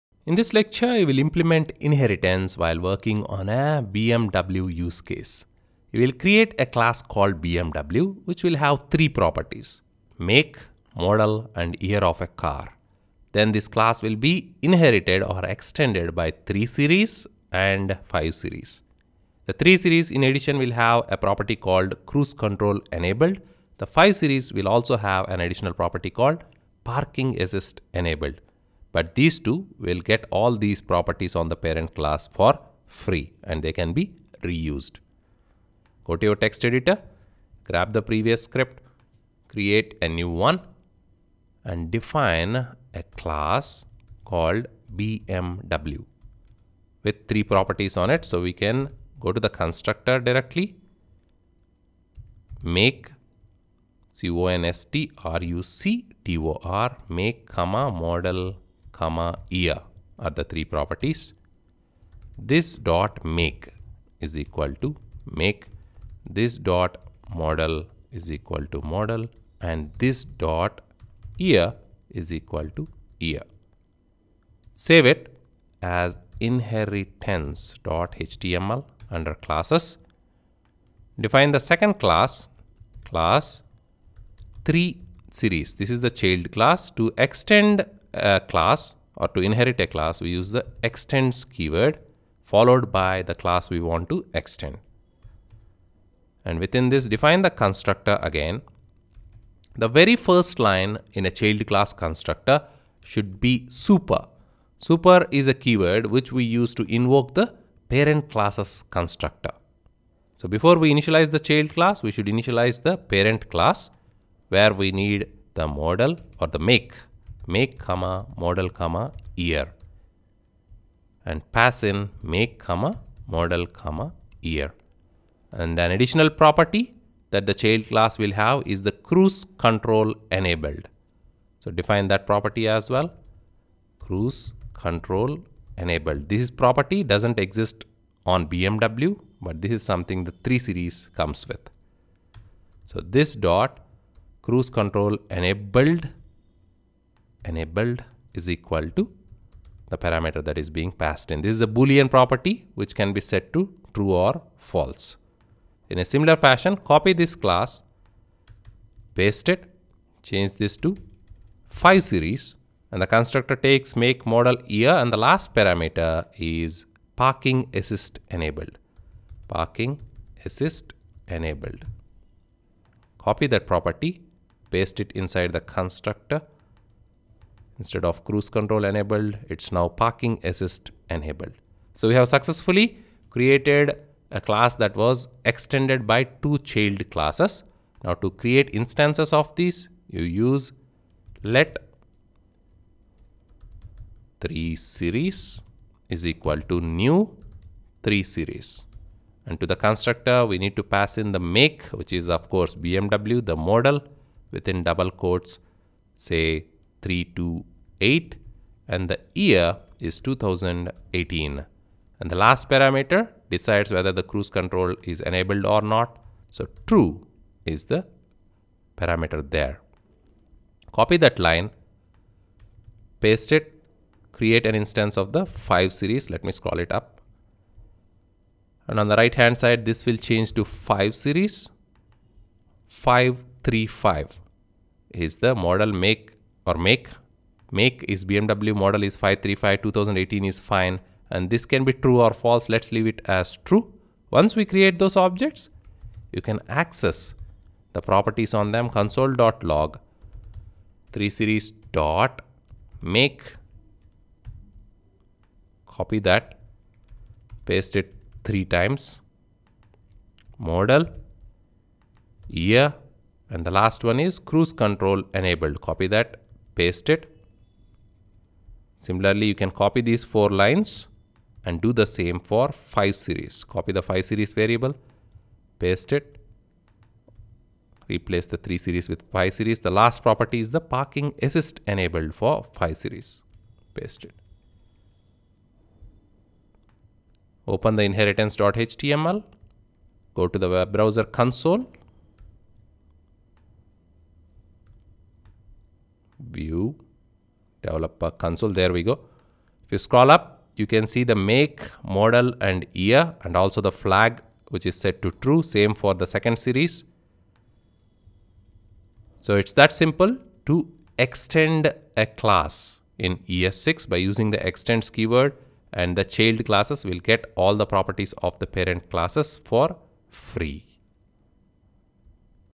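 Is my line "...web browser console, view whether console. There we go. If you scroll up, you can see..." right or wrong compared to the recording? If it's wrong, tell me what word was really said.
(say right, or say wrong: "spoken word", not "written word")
wrong: "developer", not "whether".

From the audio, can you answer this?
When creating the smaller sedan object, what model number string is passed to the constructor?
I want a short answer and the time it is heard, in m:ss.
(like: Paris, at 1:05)
328, at 3:27.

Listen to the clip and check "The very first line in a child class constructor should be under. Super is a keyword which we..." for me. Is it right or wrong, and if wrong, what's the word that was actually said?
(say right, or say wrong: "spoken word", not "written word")
wrong: "super", not "under".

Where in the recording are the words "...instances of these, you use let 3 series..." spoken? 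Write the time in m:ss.
3:08.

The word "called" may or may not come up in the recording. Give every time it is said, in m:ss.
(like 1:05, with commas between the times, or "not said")
0:07, 0:21, 0:26, 0:44.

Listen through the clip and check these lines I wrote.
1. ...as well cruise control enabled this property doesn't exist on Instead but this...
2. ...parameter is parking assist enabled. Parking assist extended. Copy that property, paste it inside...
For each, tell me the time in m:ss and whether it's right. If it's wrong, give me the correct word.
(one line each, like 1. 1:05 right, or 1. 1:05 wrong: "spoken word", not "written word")
1. 2:12 wrong: "BMW", not "Instead"
2. 2:45 wrong: "enabled", not "extended".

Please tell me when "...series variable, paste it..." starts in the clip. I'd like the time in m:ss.
4:34.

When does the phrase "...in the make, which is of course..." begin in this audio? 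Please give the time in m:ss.
3:21.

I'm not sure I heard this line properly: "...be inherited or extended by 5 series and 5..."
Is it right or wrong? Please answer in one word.
wrong.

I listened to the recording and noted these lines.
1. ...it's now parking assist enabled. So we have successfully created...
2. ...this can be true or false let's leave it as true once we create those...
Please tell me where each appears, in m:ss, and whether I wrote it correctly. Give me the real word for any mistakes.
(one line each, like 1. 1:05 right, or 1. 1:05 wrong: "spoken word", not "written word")
1. 2:59 right
2. 4:01 right.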